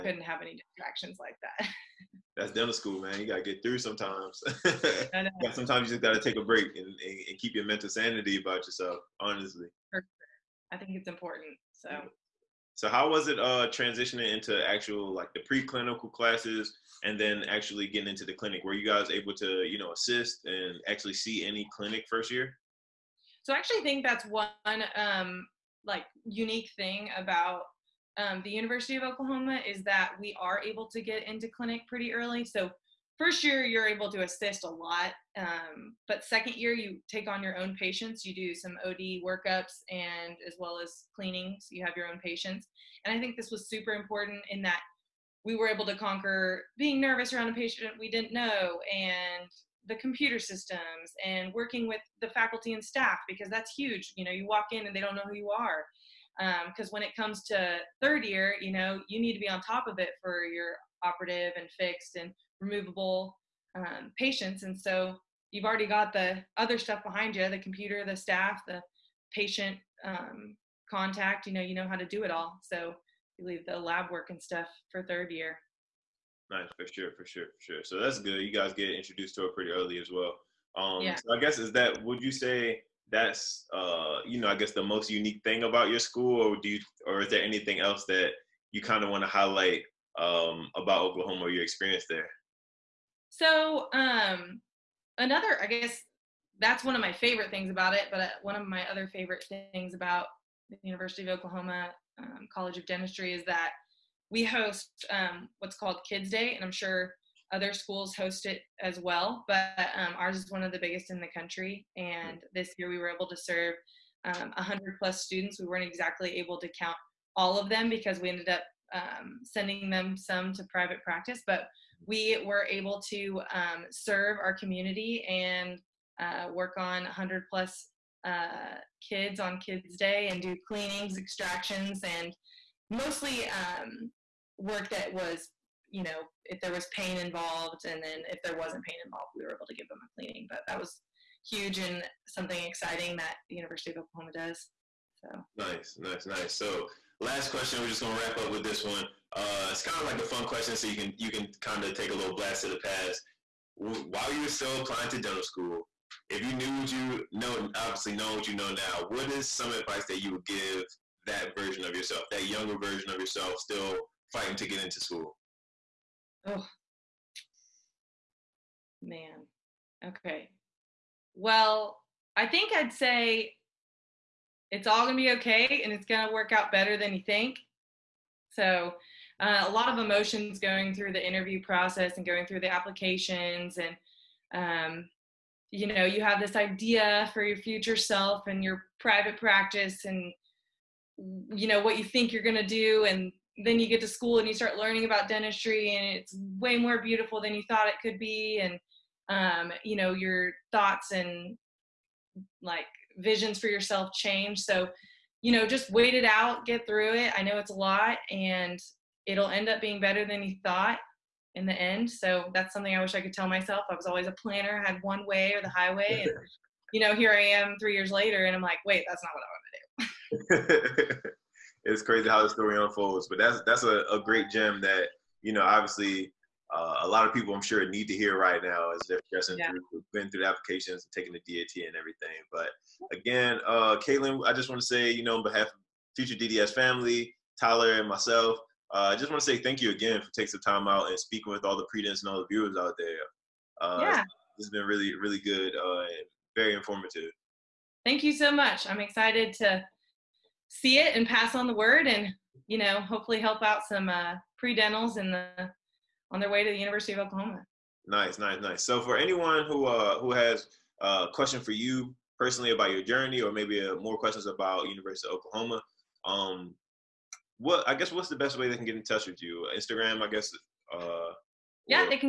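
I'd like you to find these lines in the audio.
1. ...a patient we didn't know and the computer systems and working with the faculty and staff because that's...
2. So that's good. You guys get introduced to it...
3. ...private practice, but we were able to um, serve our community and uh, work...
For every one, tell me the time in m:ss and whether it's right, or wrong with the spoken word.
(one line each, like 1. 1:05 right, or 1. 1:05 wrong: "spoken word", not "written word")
1. 0:47 right
2. 1:17 right
3. 2:00 right.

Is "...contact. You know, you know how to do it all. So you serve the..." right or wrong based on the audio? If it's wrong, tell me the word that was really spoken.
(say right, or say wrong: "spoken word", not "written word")
wrong: "leave", not "serve".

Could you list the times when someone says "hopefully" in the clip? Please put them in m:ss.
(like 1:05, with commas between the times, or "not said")
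4:13.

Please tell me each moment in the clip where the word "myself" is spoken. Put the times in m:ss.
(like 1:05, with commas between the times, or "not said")
3:33, 3:58.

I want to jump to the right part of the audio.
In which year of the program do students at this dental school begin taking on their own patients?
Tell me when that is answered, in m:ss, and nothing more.
0:36.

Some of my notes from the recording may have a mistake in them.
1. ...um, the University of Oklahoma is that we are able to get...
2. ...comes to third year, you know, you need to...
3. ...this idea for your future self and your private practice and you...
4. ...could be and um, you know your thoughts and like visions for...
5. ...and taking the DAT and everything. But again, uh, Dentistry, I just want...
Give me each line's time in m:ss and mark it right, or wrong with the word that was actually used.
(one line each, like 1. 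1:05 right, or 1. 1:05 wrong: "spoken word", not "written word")
1. 0:28 right
2. 0:57 right
3. 3:06 right
4. 3:18 right
5. 3:51 wrong: "Caytlin", not "Dentistry".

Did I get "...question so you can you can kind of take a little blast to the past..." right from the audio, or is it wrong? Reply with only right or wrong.
right.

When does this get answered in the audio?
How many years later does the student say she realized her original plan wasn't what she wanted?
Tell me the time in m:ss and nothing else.
3:37.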